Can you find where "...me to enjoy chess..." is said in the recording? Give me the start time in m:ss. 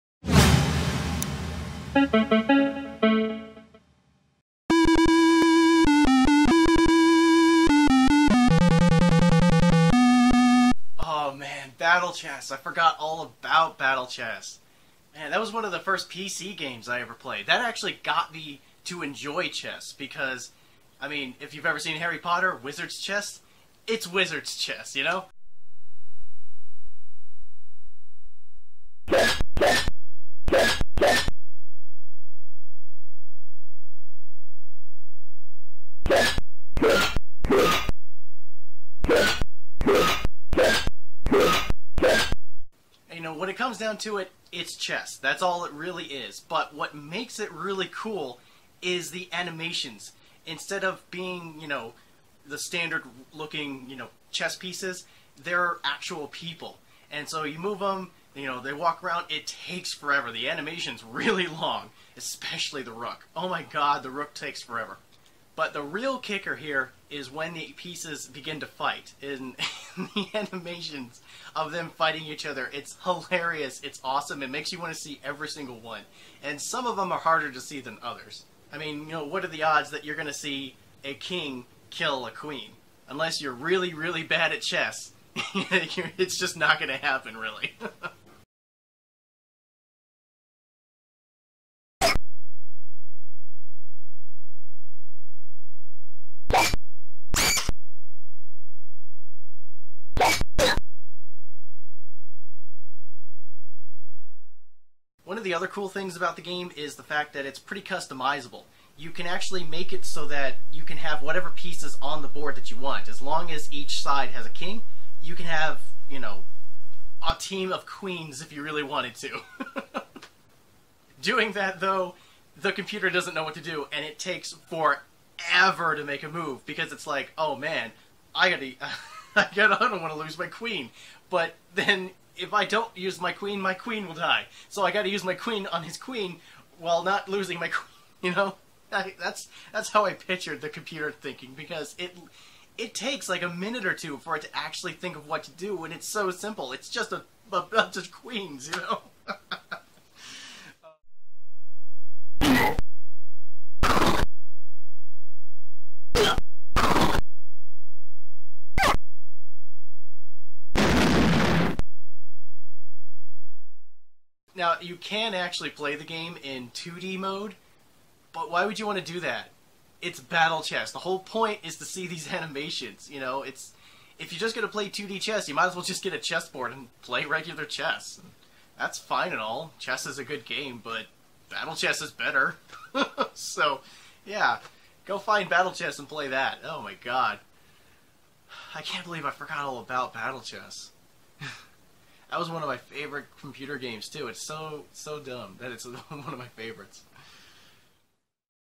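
0:18.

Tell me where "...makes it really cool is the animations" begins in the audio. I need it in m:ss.
0:46.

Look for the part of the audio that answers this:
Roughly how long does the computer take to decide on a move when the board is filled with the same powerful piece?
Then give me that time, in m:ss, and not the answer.
2:23.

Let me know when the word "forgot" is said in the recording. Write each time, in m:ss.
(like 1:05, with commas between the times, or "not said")
0:12, 3:09.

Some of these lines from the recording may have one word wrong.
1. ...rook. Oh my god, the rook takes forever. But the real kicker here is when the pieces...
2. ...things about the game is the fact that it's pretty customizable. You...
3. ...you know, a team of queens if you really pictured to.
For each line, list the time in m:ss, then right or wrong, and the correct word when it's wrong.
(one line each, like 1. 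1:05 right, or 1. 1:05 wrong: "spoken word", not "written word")
1. 1:02 right
2. 1:45 right
3. 1:56 wrong: "wanted", not "pictured".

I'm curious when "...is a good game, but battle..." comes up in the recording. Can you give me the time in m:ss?
3:00.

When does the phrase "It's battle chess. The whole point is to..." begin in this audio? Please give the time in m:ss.
2:50.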